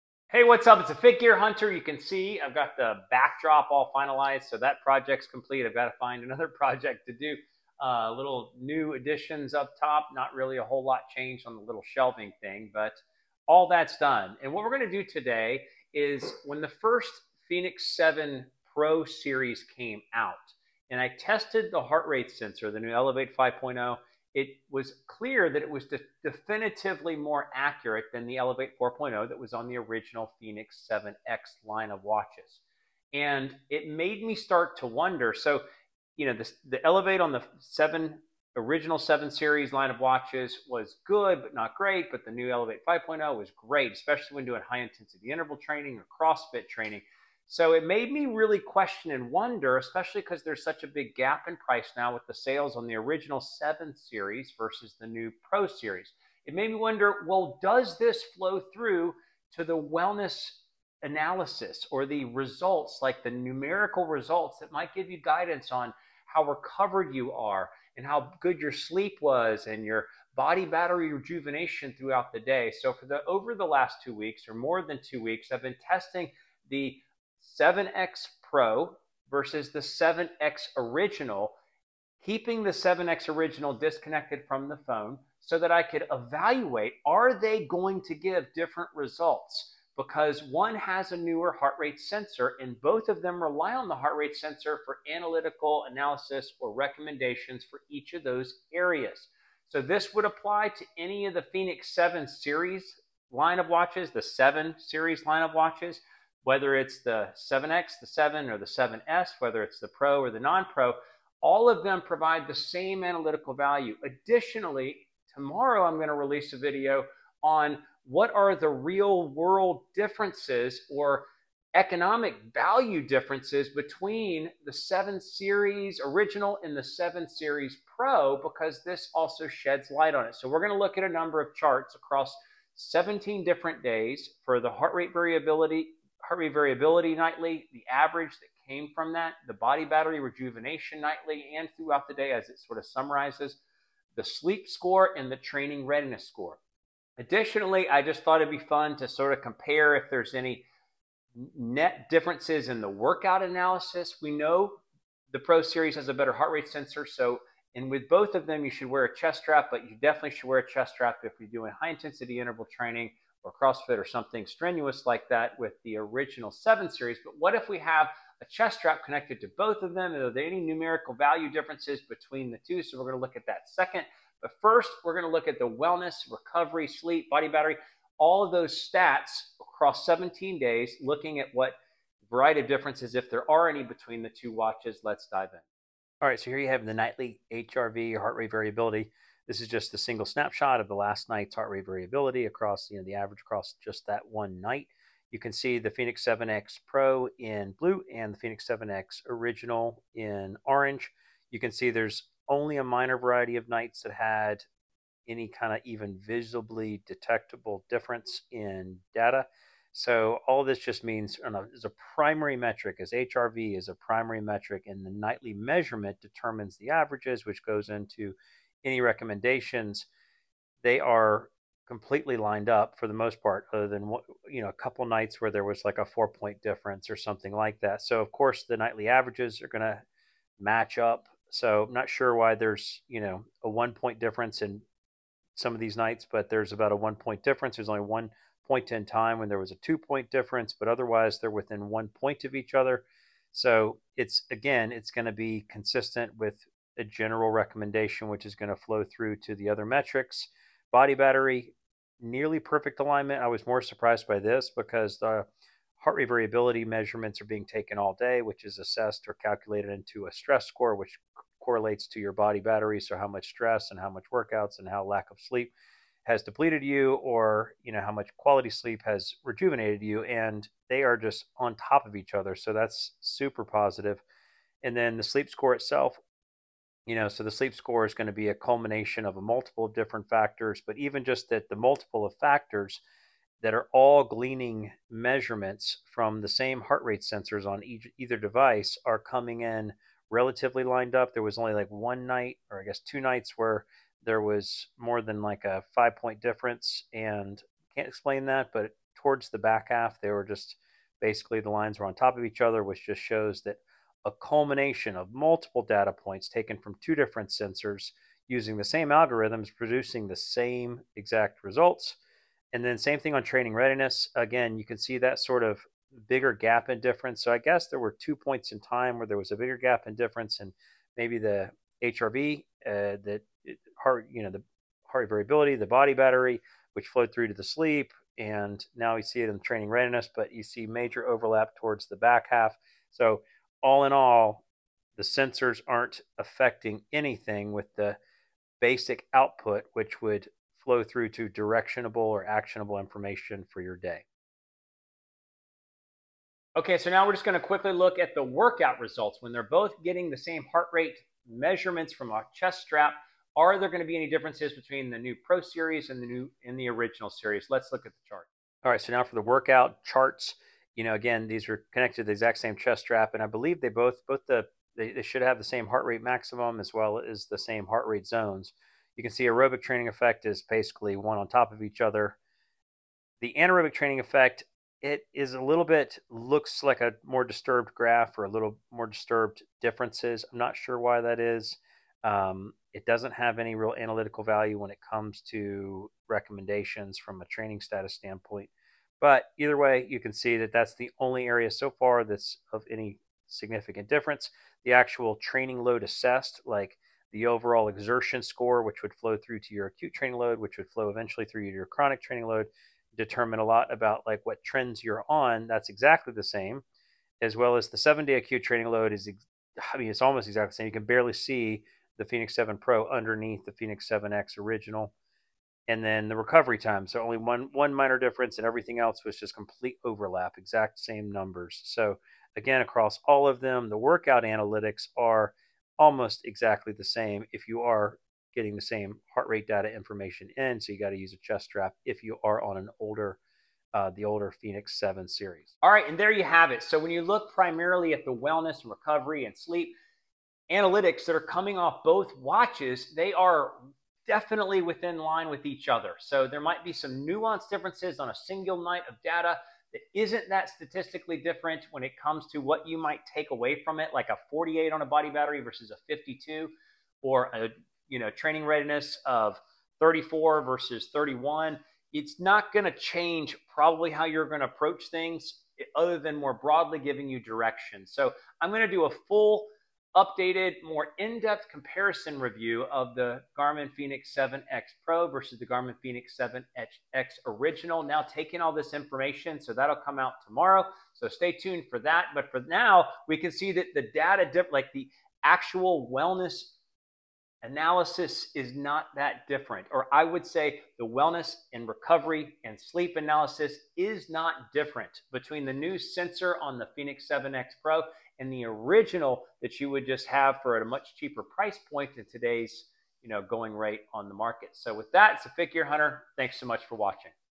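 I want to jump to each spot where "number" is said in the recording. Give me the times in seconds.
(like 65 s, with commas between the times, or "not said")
131 s, 421 s.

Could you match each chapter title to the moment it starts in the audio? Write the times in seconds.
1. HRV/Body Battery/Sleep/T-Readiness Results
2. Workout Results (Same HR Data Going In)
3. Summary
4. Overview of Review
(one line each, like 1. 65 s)
1. 185 s
2. 347 s
3. 435 s
4. 56 s.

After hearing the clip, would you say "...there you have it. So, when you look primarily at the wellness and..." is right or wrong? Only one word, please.
right.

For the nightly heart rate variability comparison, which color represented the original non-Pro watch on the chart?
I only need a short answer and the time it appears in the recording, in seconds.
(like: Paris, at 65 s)
orange, at 200 s.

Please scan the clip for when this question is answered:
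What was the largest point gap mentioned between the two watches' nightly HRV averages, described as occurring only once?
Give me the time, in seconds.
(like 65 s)
239 s.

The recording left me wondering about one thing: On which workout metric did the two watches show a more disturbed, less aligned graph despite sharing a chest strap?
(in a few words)
anaerobic training effect.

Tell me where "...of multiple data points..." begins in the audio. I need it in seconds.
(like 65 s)
305 s.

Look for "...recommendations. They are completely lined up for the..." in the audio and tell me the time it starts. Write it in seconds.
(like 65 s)
219 s.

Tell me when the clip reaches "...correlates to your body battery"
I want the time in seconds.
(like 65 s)
261 s.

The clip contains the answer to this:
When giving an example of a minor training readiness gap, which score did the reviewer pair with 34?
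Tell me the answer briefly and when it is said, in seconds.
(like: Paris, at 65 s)
31, at 461 s.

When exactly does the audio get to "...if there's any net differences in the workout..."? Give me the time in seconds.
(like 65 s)
149 s.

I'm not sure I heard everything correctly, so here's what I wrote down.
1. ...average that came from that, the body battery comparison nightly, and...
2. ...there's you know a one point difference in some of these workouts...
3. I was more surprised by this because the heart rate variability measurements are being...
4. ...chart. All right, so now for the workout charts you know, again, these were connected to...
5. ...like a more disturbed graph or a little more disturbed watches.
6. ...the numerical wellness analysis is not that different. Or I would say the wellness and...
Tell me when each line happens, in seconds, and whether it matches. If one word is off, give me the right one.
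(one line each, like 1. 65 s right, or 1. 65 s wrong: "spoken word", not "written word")
1. 137 s wrong: "rejuvenation", not "comparison"
2. 232 s wrong: "nights", not "workouts"
3. 253 s right
4. 358 s right
5. 376 s wrong: "differences", not "watches"
6. 484 s wrong: "actual", not "numerical".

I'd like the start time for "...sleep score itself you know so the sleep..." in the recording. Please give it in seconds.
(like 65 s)
275 s.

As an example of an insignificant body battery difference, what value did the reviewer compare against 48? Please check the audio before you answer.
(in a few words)
52.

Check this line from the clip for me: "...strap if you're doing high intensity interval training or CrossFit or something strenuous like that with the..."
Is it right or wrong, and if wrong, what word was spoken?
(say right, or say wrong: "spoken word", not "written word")
right.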